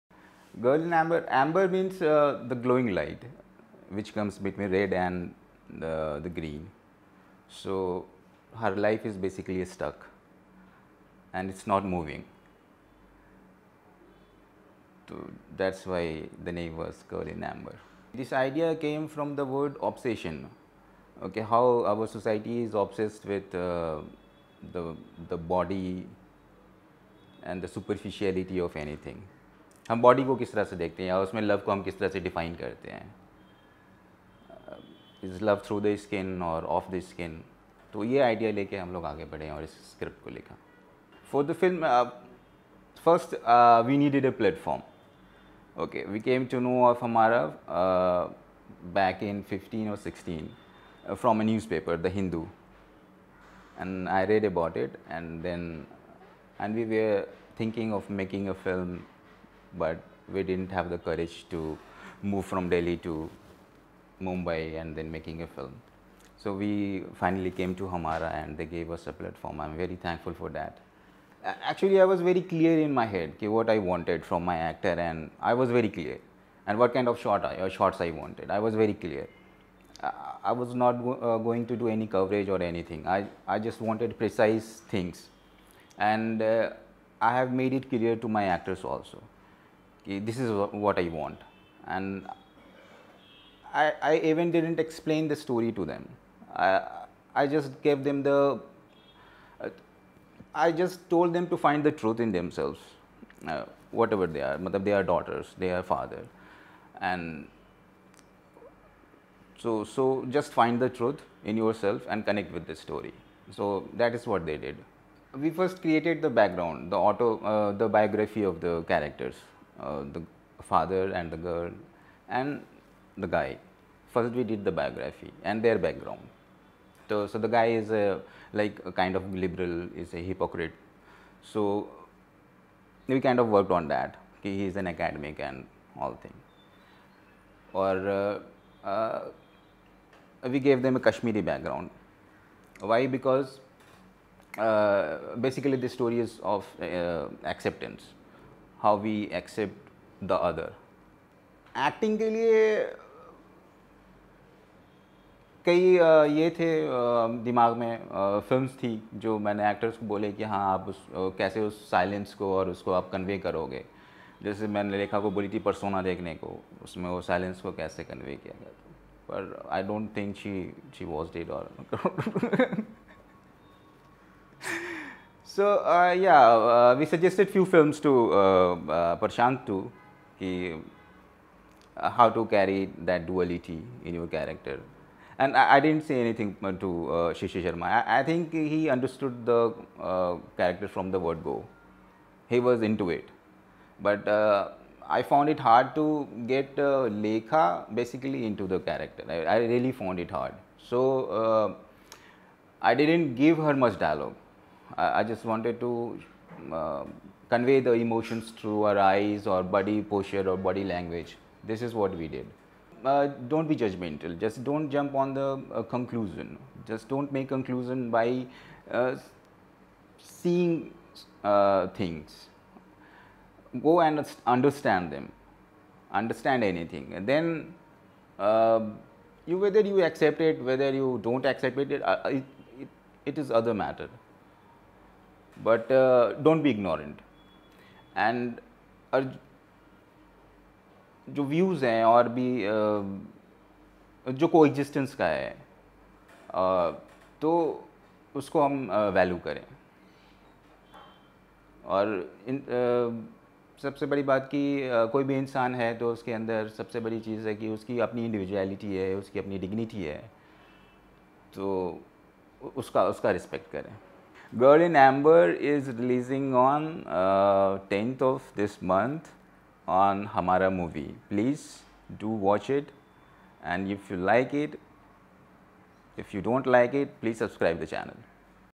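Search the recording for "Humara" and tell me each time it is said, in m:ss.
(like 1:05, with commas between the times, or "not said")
1:07, 4:30.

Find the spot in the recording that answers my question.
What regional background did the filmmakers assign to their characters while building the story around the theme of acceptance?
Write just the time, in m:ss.
2:20.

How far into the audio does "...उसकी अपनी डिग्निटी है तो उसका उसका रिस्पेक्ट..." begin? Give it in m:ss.
4:19.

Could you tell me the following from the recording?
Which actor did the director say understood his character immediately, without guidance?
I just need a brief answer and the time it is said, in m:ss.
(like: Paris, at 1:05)
Shishi Sharma, at 3:07.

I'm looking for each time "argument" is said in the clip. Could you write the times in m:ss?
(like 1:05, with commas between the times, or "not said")
not said.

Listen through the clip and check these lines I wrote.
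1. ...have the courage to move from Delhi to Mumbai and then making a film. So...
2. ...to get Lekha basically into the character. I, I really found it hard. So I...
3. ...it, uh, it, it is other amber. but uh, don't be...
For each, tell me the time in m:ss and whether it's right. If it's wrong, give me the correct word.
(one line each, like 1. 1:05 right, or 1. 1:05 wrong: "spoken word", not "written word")
1. 1:00 right
2. 3:15 right
3. 3:51 wrong: "matter", not "amber".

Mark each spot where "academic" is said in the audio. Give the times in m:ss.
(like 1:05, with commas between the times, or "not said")
2:14.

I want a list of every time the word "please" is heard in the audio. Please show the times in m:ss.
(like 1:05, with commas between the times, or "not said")
4:31, 4:37.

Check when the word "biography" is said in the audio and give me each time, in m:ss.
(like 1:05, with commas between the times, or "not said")
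1:57, 2:04.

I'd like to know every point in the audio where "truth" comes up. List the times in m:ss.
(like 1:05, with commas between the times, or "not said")
1:41, 1:50.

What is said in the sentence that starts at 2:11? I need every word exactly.
So we kind of worked on that.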